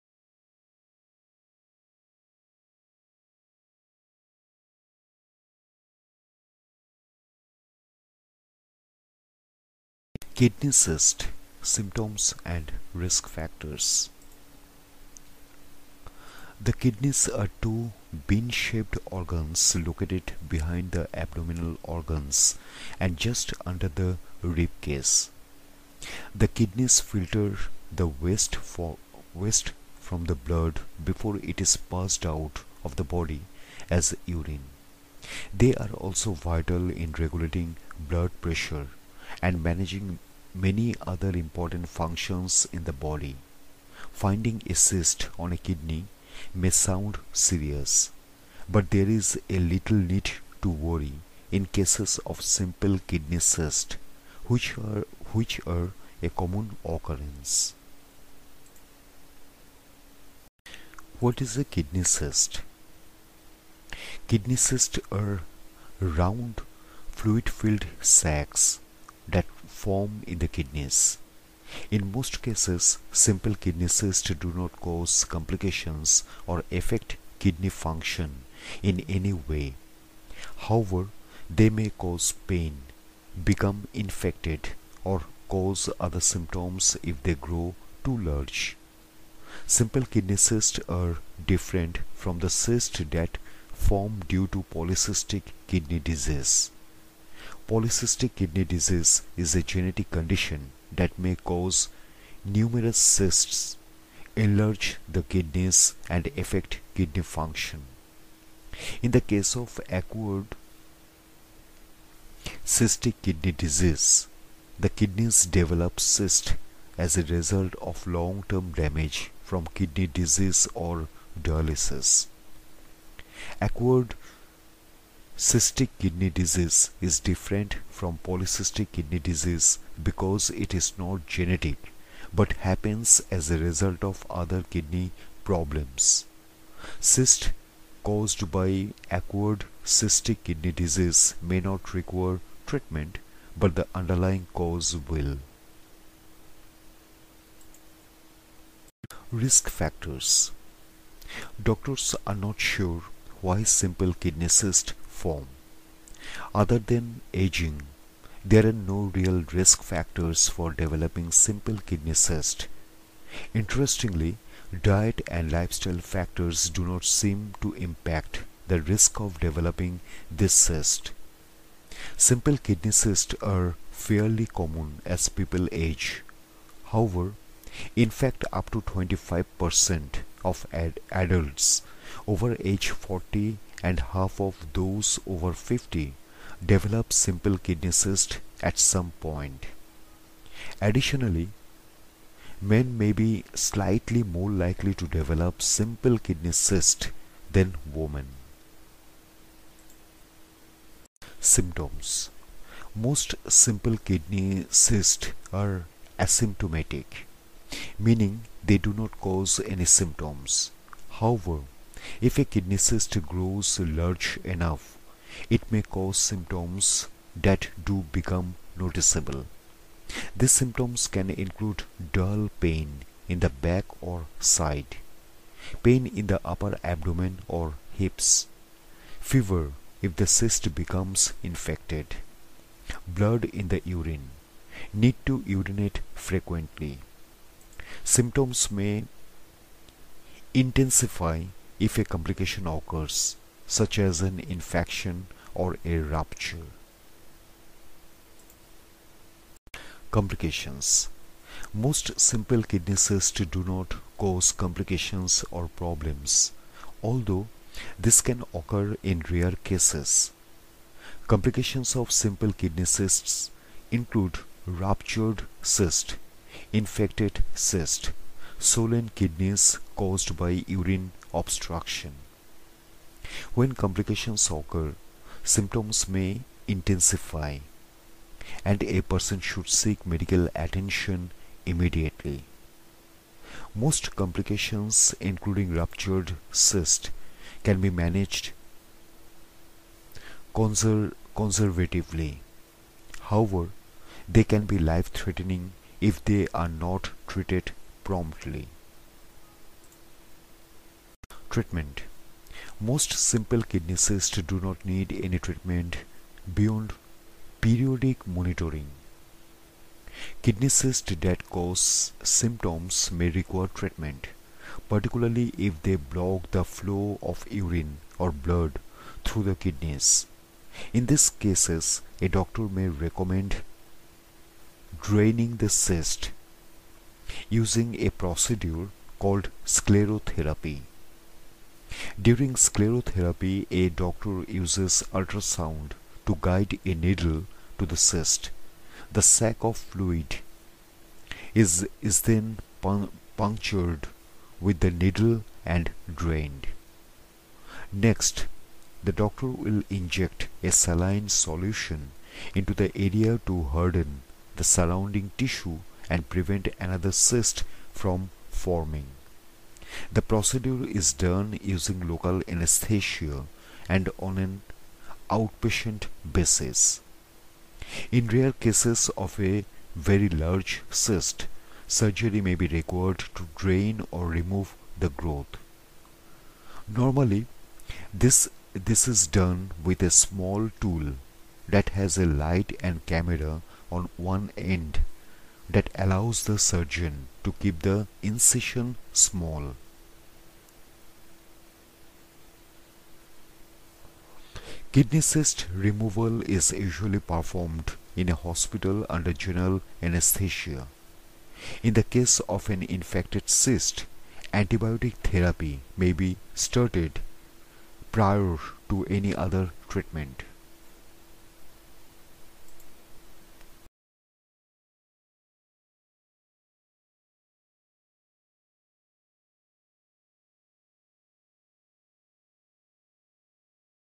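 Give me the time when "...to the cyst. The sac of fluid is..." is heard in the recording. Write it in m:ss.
5:37.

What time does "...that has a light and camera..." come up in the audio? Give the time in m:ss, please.
6:21.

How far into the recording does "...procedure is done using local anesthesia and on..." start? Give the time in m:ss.
6:00.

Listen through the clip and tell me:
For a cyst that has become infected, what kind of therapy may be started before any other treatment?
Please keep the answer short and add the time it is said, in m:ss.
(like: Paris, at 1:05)
antibiotic therapy, at 6:44.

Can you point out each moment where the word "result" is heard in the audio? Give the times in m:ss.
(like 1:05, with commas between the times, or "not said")
1:57, 2:13.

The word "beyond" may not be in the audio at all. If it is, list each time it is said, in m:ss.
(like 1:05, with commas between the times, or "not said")
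5:06.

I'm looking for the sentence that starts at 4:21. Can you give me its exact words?
Complications of simple kidney cysts include ruptured cyst, infected cyst, swollen kidneys caused by urine obstruction.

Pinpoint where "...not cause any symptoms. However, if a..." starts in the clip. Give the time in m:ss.
3:28.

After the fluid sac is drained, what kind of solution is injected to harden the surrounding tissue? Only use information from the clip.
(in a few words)
saline solution.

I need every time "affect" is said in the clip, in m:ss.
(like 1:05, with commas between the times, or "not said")
1:16, 1:46.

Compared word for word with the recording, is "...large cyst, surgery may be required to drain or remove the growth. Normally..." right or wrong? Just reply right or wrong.
right.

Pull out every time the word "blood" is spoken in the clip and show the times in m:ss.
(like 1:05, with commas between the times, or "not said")
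0:30, 0:38, 3:53, 5:18.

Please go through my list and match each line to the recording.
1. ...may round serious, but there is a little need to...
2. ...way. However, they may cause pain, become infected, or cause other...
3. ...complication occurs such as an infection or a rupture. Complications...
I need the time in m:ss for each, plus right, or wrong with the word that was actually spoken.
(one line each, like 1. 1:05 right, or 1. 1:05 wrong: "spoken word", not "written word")
1. 0:46 wrong: "sound", not "round"
2. 1:19 right
3. 4:02 right.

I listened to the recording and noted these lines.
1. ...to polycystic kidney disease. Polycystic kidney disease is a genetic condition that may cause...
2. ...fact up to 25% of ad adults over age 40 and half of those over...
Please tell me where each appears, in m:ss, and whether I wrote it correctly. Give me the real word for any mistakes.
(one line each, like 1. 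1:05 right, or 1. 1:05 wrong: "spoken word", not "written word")
1. 1:34 right
2. 2:58 right.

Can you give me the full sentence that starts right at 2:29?
Risk factors Doctors are not sure why simple kidney cysts form.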